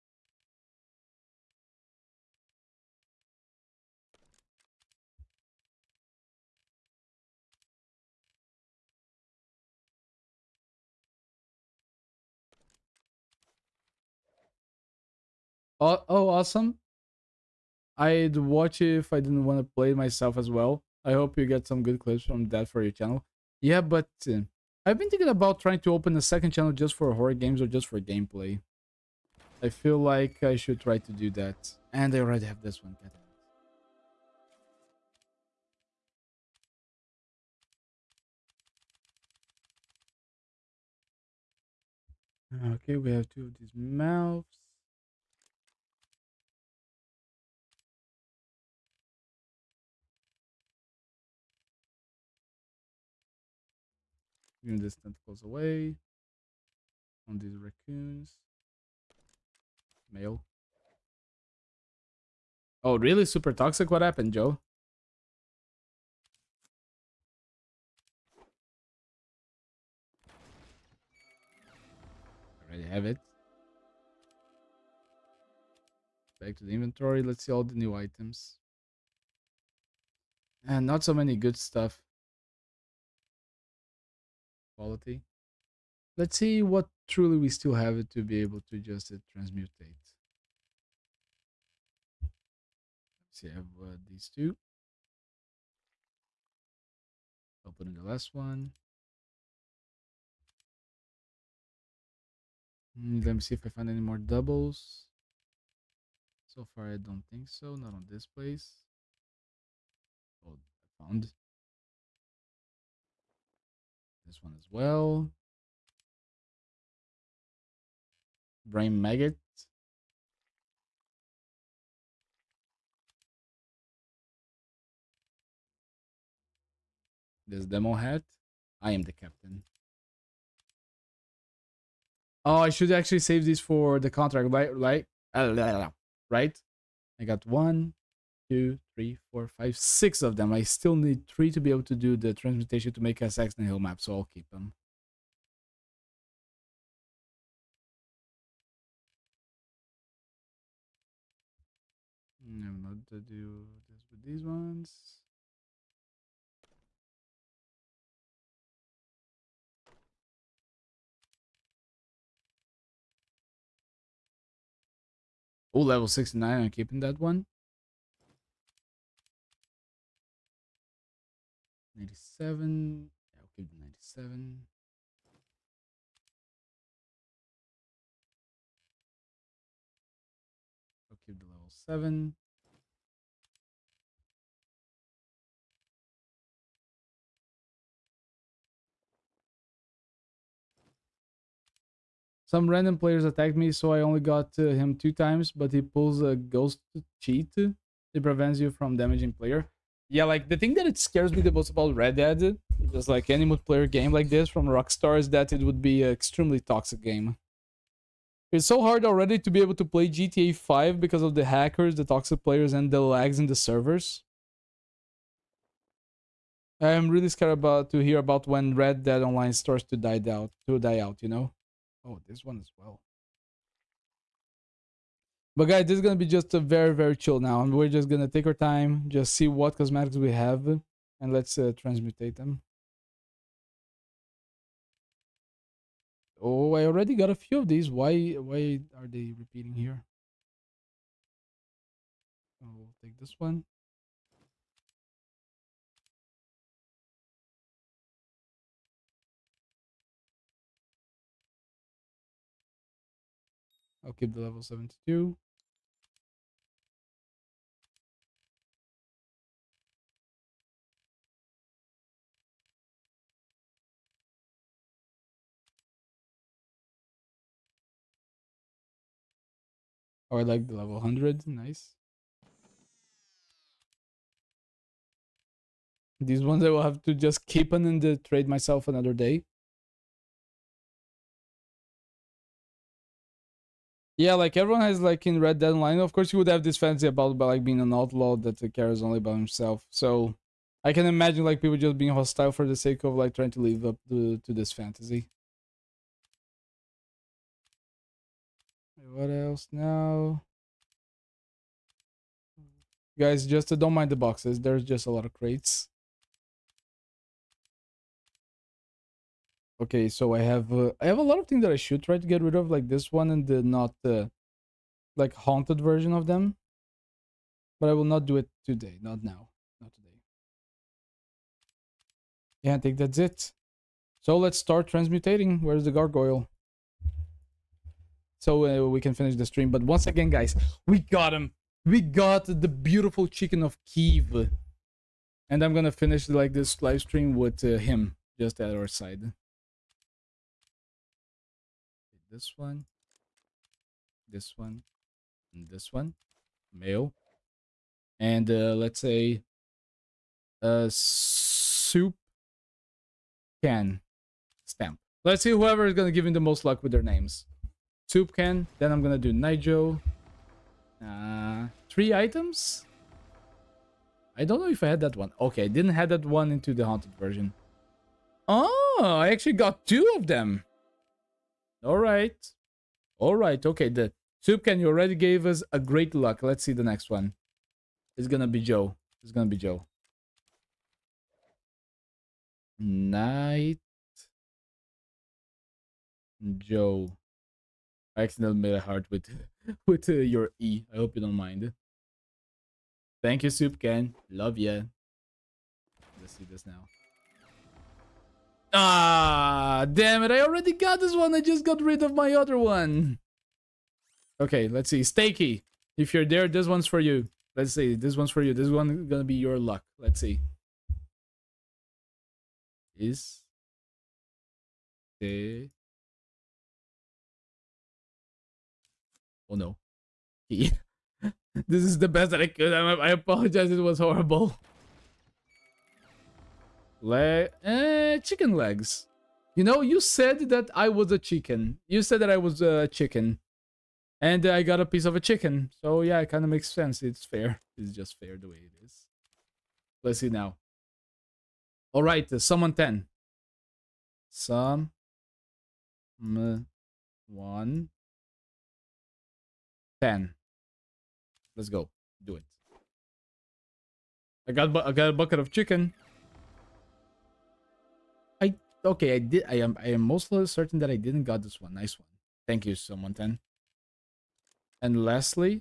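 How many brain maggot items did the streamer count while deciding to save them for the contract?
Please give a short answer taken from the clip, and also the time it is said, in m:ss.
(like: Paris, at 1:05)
6, at 2:19.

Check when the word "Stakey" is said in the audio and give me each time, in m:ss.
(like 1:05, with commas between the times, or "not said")
6:45.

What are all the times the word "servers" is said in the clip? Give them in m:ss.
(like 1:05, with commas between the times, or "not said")
3:33.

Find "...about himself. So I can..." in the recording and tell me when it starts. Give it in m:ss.
4:49.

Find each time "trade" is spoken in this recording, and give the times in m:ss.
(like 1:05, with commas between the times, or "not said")
4:38.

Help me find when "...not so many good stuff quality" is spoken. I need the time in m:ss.
1:20.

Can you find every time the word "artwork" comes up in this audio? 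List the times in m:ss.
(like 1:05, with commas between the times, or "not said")
not said.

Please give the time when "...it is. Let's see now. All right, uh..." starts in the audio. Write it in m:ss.
7:18.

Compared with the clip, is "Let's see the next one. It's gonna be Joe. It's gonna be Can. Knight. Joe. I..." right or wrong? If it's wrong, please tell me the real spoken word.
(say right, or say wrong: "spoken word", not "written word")
wrong: "Joe", not "Can".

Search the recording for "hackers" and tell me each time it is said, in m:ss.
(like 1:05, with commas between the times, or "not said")
3:31.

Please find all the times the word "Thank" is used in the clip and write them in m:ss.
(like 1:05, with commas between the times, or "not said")
6:33, 7:42.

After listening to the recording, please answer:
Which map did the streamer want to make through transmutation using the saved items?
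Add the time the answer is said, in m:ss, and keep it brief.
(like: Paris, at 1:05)
Saxon Hill, at 2:23.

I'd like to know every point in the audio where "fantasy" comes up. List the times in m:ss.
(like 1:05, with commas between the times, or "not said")
4:46, 4:54.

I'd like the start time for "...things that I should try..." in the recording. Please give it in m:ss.
5:11.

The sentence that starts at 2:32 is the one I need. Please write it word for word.
I'm not to do this with these ones.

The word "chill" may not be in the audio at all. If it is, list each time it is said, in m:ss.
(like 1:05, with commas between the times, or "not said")
3:47.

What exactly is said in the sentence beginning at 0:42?
Okay, we have two of these mouths.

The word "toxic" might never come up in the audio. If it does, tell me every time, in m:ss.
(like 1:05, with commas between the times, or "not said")
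1:03, 3:26, 3:32.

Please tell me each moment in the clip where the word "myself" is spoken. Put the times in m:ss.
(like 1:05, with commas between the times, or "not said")
0:19, 4:38.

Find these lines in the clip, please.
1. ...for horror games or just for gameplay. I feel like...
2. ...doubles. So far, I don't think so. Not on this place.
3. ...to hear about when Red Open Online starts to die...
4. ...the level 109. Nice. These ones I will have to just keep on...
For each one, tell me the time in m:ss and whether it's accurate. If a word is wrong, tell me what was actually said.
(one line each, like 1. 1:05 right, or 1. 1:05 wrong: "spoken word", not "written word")
1. 0:26 right
2. 1:44 right
3. 3:37 wrong: "Dead", not "Open"
4. 4:30 wrong: "100", not "109".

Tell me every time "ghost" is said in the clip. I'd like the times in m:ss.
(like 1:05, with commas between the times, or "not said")
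3:16.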